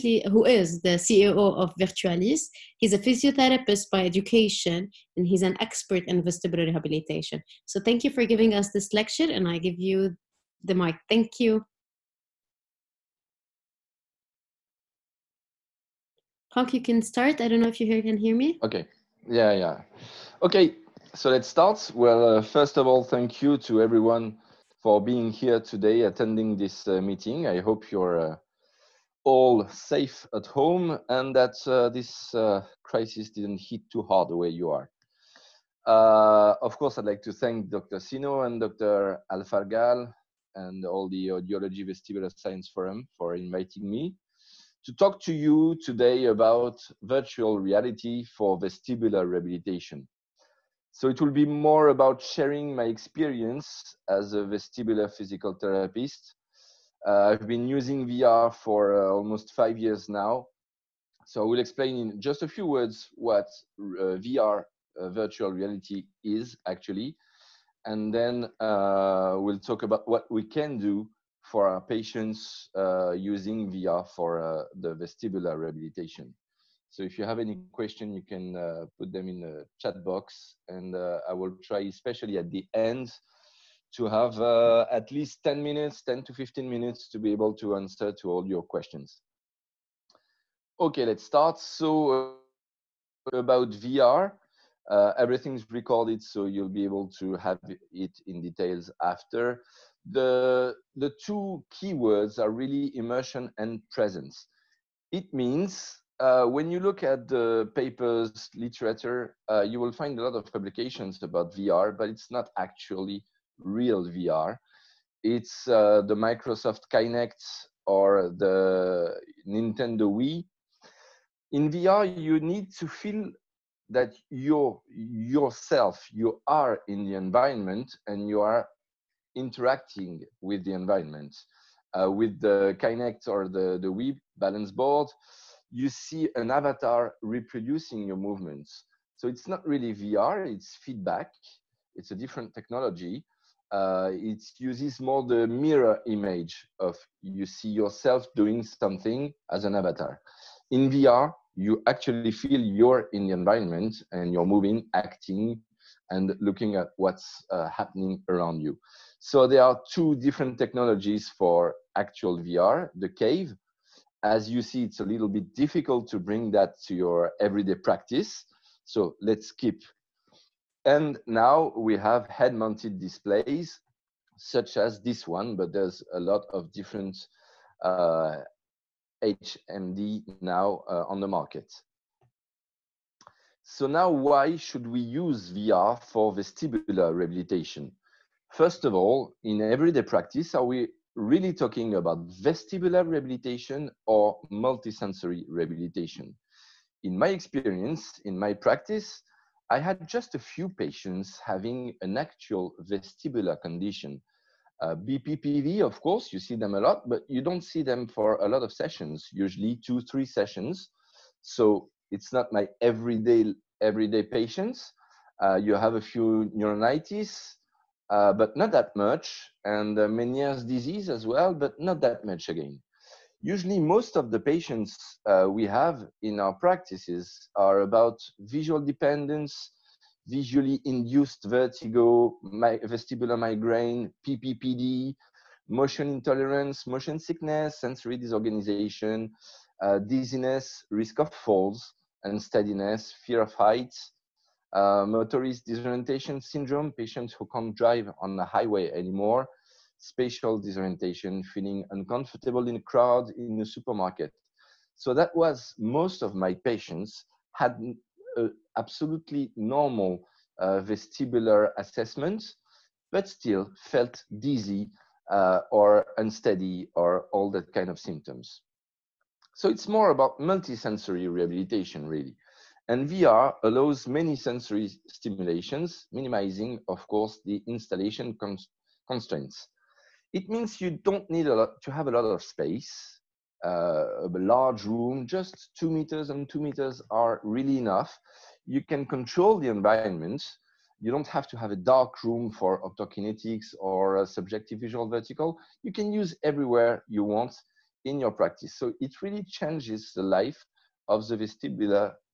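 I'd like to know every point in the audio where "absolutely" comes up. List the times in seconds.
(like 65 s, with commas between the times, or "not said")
258 s.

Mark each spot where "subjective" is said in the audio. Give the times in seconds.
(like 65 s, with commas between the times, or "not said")
294 s.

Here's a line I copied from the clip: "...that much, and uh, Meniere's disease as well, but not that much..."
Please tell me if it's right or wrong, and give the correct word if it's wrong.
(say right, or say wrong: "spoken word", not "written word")
right.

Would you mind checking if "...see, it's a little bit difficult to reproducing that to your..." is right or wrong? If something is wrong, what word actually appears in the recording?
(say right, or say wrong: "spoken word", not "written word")
wrong: "bring", not "reproducing".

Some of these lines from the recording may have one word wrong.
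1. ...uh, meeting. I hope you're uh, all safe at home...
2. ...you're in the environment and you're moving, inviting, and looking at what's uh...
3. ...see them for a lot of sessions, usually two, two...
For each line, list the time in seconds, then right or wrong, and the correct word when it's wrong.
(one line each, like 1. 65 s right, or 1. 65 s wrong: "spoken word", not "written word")
1. 26 s right
2. 152 s wrong: "acting", not "inviting"
3. 207 s wrong: "three", not "two".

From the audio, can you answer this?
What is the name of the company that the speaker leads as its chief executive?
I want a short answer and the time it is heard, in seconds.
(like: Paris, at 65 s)
Virtualis, at 1 s.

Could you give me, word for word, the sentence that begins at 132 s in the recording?
Uh, with the Kinect or the, the Wii balance board, you see an avatar reproducing your movements.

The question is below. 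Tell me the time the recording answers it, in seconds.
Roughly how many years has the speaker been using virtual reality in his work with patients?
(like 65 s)
59 s.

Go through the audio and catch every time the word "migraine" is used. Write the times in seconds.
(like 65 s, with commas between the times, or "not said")
233 s.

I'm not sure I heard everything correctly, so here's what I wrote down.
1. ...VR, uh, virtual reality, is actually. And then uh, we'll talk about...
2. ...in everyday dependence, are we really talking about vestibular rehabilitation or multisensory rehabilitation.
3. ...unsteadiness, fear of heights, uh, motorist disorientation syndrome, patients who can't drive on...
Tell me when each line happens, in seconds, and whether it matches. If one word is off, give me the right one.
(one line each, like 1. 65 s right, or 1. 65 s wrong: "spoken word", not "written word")
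1. 64 s right
2. 189 s wrong: "practice", not "dependence"
3. 242 s right.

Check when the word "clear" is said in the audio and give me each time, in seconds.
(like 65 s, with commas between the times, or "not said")
not said.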